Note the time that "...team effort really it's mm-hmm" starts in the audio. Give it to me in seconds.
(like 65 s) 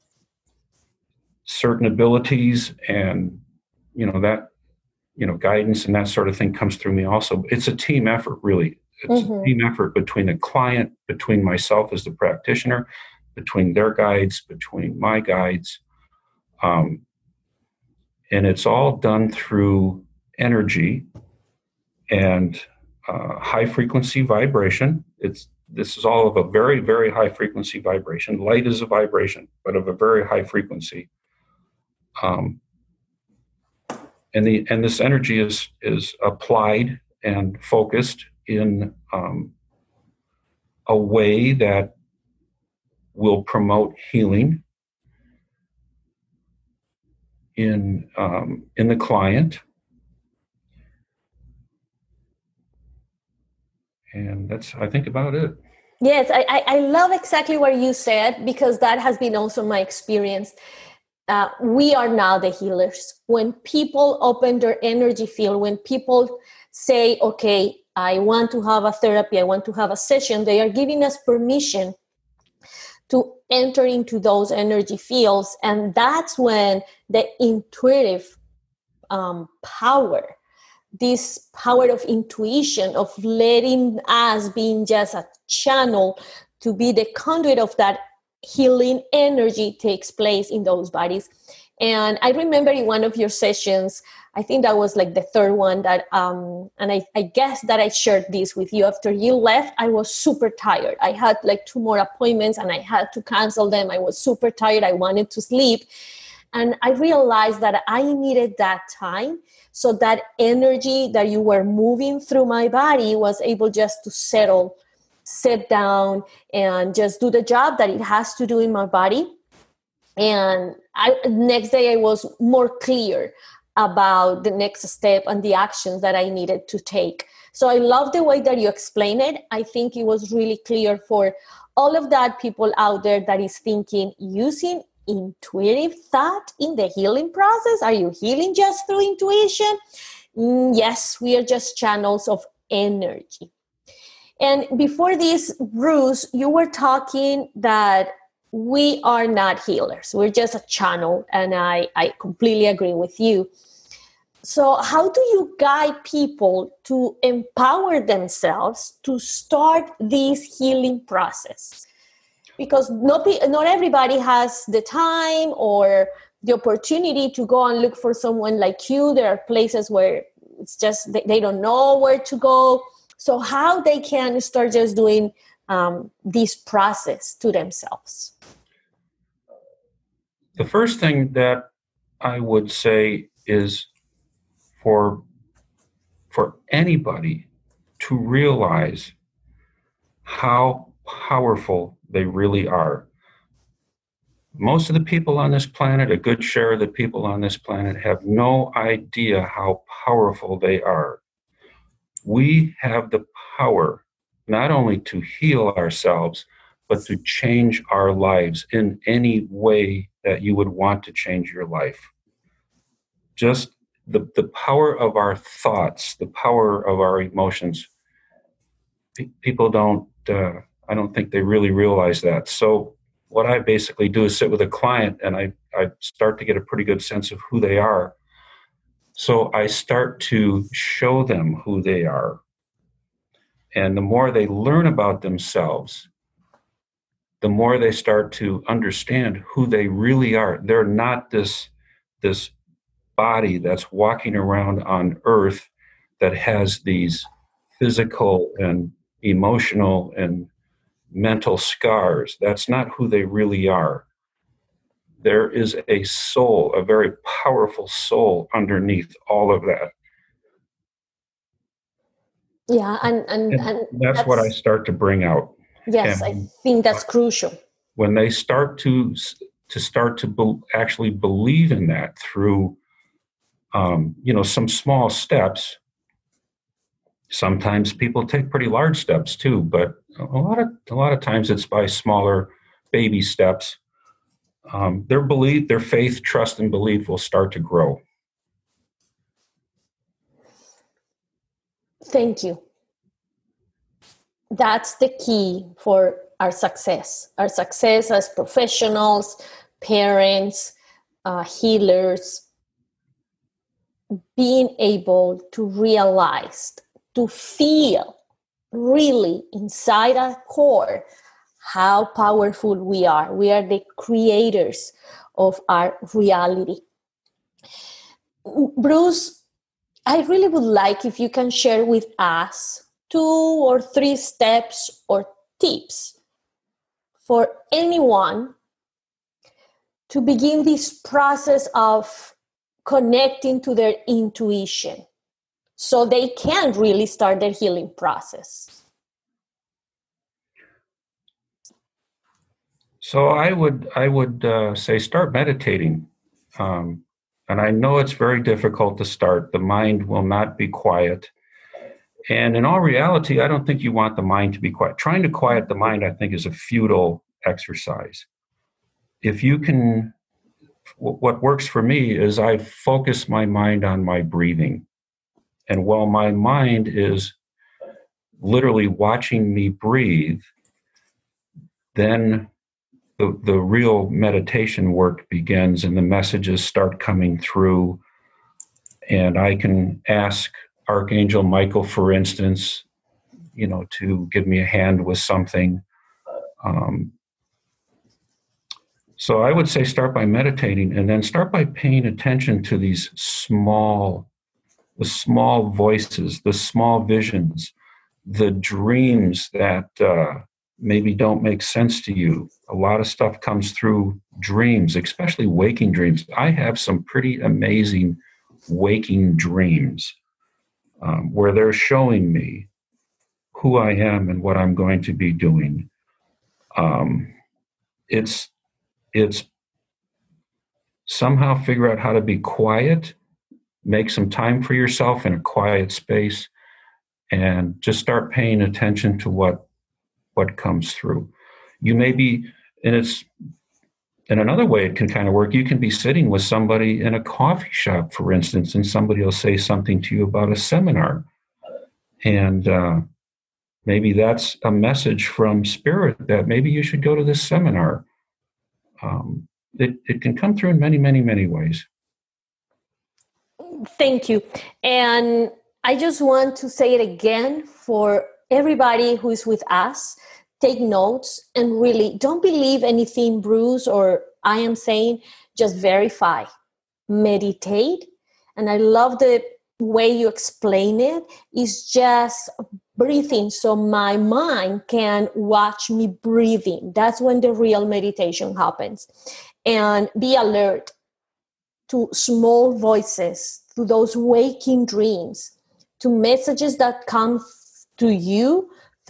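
7 s.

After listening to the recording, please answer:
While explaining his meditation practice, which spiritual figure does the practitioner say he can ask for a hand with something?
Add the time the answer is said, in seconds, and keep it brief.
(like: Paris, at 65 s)
Archangel Michael, at 380 s.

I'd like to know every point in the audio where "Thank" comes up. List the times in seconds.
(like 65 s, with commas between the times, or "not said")
292 s, 453 s.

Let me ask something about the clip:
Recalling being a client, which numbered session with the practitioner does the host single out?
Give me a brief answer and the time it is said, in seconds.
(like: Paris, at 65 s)
The third one, at 95 s.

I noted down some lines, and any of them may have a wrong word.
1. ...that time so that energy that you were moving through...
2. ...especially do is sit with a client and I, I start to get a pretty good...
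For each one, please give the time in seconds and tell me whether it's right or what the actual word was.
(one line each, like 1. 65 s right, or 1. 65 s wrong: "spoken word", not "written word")
1. 108 s right
2. 223 s wrong: "basically", not "especially".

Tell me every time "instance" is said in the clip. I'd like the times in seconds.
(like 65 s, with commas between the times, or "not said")
382 s, 438 s.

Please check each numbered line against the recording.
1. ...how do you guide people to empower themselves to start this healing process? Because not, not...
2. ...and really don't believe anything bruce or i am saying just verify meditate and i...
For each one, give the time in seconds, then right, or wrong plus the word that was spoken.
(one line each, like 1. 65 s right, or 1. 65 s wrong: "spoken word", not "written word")
1. 154 s right
2. 461 s right.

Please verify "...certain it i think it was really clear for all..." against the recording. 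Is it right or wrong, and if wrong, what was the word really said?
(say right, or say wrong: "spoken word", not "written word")
wrong: "explain", not "certain".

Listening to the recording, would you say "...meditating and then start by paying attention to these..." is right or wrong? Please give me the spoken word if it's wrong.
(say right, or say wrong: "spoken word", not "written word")
right.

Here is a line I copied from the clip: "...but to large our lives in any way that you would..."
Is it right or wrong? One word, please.
wrong.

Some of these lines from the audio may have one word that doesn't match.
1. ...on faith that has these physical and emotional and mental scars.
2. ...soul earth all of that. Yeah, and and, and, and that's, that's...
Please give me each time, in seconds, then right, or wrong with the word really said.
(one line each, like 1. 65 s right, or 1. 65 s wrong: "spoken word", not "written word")
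1. 244 s wrong: "earth", not "faith"
2. 257 s wrong: "underneath", not "earth".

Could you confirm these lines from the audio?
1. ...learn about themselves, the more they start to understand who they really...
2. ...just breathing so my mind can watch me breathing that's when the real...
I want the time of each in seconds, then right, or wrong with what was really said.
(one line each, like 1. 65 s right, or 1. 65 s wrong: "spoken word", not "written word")
1. 234 s right
2. 471 s right.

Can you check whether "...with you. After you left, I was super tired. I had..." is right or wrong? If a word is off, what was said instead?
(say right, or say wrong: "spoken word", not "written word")
right.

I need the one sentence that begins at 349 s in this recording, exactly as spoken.
The mind will not be quiet, and in all reality, I don't think you want the mind to be quiet.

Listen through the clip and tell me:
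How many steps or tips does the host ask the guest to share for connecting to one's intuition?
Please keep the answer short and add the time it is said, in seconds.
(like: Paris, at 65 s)
2 or 3, at 323 s.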